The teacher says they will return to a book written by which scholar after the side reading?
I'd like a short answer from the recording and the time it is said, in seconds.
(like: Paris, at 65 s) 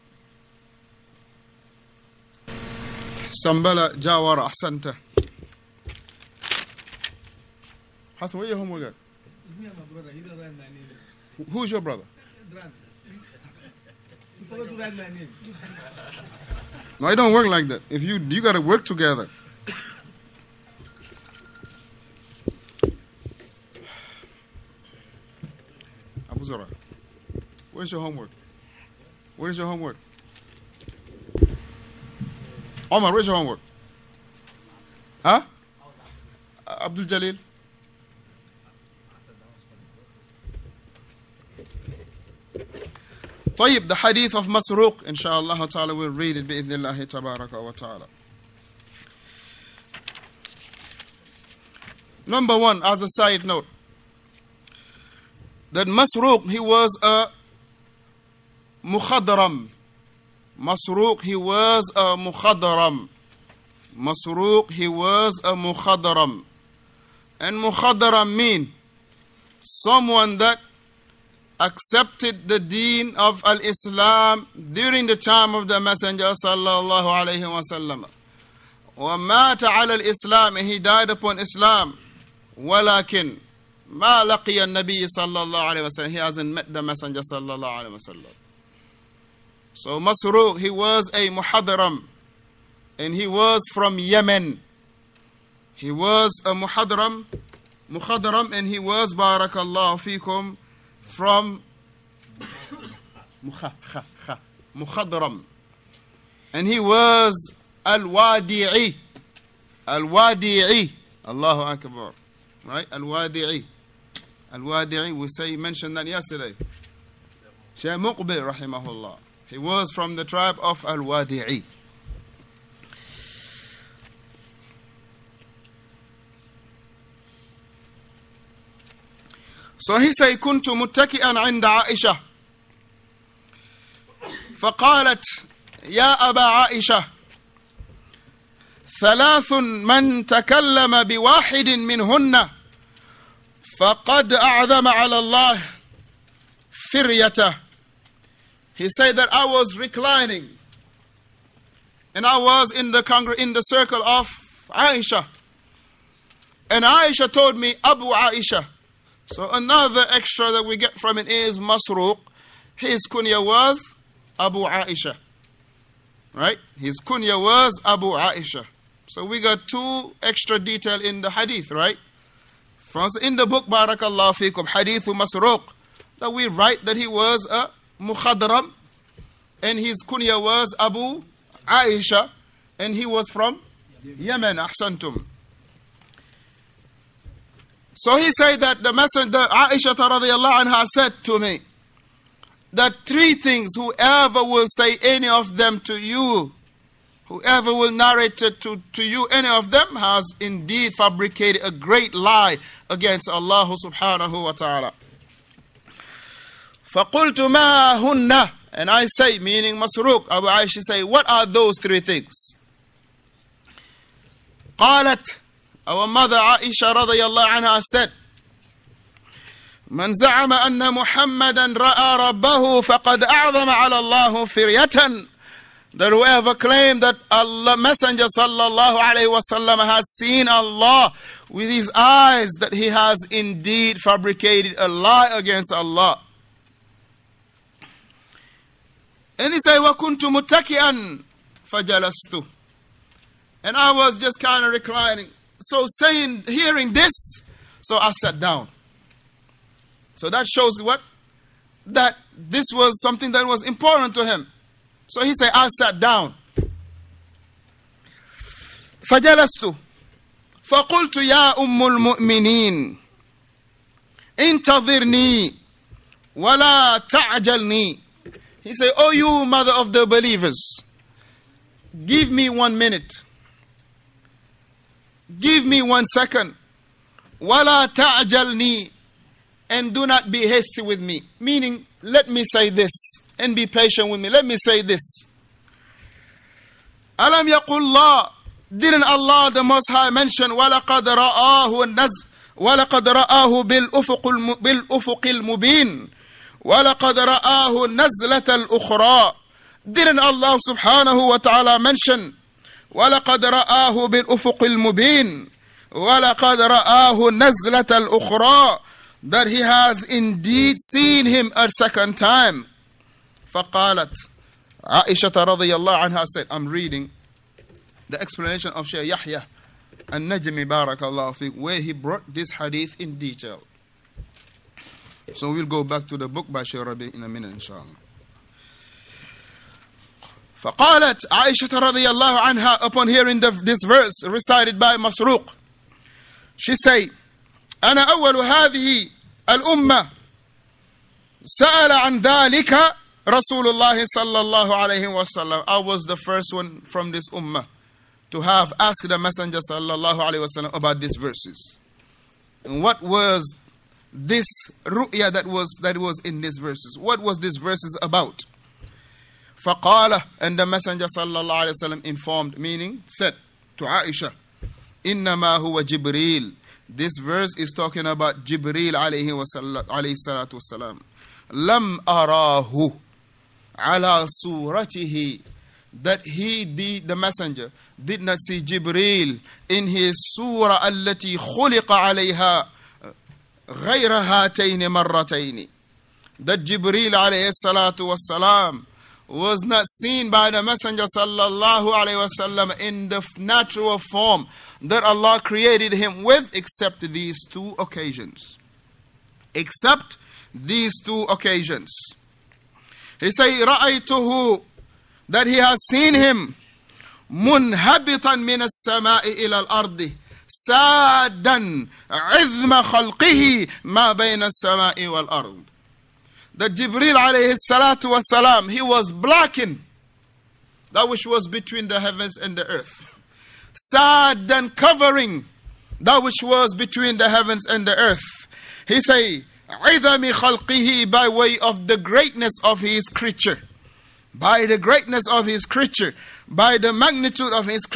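Shaykh Rabi, at 326 s.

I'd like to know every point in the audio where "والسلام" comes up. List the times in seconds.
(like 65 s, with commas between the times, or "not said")
370 s, 388 s.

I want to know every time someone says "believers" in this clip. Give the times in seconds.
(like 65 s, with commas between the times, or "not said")
270 s.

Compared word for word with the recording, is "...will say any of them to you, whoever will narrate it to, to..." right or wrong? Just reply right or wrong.
right.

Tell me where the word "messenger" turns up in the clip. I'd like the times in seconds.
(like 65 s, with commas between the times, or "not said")
75 s, 86 s, 188 s, 227 s, 349 s, 360 s, 377 s, 390 s.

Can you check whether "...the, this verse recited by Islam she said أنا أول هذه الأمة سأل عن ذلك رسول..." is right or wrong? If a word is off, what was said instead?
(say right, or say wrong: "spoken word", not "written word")
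wrong: "Masruq", not "Islam".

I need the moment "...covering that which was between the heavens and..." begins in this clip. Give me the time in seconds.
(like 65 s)
424 s.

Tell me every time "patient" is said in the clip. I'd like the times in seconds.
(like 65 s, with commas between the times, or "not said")
283 s.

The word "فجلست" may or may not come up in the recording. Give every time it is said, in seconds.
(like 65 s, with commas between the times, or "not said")
241 s, 259 s.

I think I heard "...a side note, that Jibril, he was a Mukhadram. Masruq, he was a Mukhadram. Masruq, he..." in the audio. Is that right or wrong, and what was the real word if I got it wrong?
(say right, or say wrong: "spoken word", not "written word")
wrong: "Masruq", not "Jibril".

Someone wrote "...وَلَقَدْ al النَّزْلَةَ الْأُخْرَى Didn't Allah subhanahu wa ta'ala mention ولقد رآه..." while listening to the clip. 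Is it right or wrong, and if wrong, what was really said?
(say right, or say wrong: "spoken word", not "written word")
right.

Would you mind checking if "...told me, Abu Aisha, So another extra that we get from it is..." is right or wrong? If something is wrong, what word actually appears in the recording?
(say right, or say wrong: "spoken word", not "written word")
right.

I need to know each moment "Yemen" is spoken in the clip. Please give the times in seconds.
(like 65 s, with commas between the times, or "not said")
93 s, 184 s.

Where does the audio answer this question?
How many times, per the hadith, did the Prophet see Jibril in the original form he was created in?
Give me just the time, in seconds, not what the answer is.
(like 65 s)
384 s.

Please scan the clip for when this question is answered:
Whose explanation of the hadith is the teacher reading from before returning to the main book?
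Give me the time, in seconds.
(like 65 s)
318 s.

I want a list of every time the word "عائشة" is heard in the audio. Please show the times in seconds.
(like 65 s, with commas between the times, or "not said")
131 s, 136 s, 314 s.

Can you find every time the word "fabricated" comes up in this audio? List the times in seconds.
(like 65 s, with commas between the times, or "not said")
200 s, 233 s.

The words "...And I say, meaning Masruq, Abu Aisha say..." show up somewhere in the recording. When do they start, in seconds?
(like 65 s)
208 s.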